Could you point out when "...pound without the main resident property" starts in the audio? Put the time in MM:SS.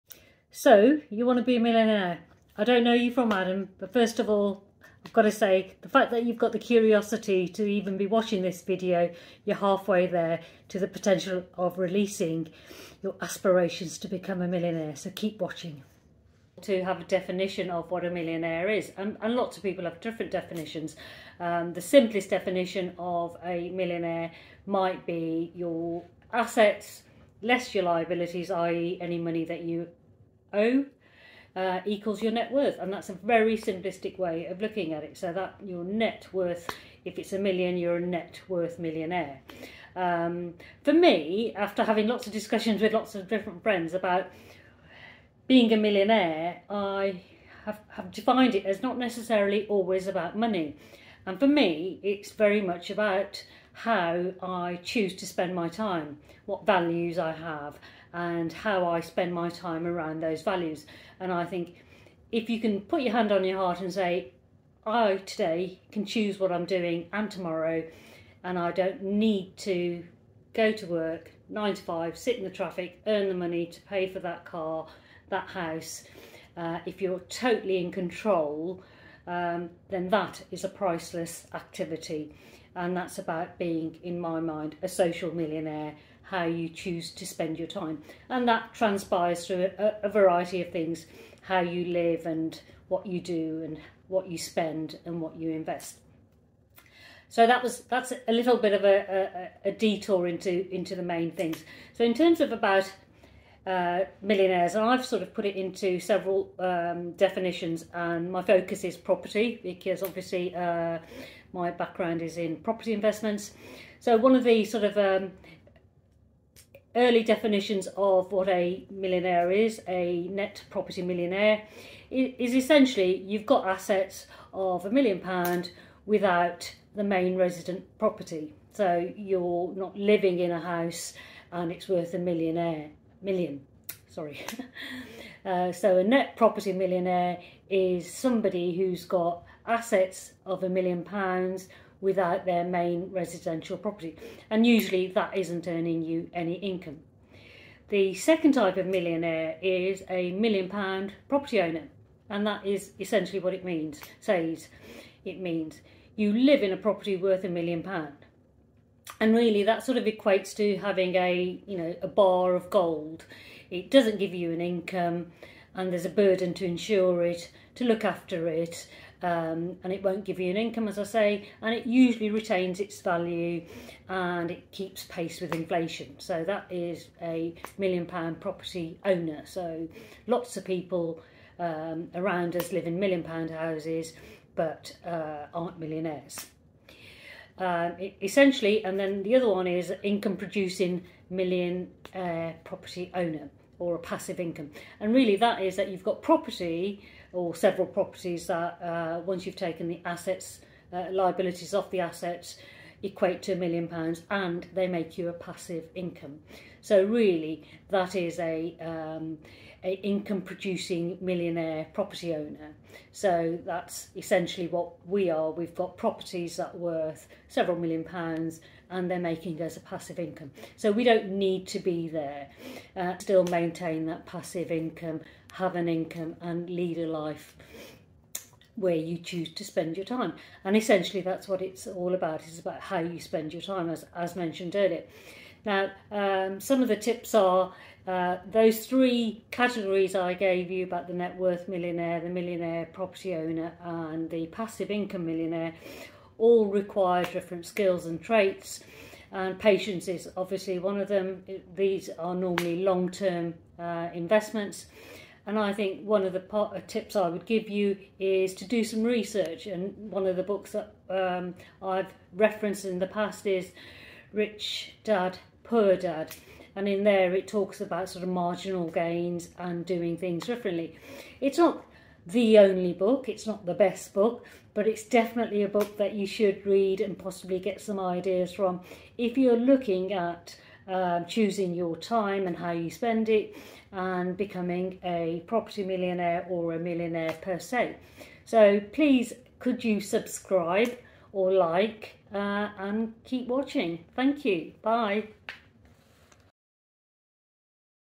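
02:05.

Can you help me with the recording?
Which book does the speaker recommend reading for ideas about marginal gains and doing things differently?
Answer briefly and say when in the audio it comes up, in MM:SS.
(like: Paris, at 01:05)
Rich Dad, Poor Dad, at 04:24.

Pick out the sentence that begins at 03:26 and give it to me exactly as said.
So really that is a, um, a income producing millionaire property owner.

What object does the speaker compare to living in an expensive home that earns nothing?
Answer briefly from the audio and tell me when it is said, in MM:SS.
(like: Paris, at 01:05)
a bar of gold, at 02:42.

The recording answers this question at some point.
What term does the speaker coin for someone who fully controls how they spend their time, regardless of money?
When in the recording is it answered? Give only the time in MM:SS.
01:24.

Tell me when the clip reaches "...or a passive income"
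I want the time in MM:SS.
03:13.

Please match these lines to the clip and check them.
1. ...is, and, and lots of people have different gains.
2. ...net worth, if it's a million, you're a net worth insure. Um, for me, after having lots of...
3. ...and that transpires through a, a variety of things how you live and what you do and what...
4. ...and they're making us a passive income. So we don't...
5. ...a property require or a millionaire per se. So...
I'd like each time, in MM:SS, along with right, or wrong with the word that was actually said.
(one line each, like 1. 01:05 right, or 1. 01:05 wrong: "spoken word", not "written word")
1. 00:18 wrong: "definitions", not "gains"
2. 00:35 wrong: "millionaire", not "insure"
3. 01:28 right
4. 03:38 right
5. 04:45 wrong: "millionaire", not "require".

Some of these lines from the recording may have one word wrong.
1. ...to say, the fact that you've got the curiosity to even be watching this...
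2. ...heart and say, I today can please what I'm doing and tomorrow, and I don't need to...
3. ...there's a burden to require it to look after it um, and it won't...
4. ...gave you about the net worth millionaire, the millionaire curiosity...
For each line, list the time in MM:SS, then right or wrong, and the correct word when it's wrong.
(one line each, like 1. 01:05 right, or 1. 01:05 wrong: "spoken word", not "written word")
1. 00:05 right
2. 01:03 wrong: "choose", not "please"
3. 02:45 wrong: "insure", not "require"
4. 04:00 wrong: "property", not "curiosity".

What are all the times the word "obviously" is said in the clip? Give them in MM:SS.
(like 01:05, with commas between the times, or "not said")
01:50, 04:10.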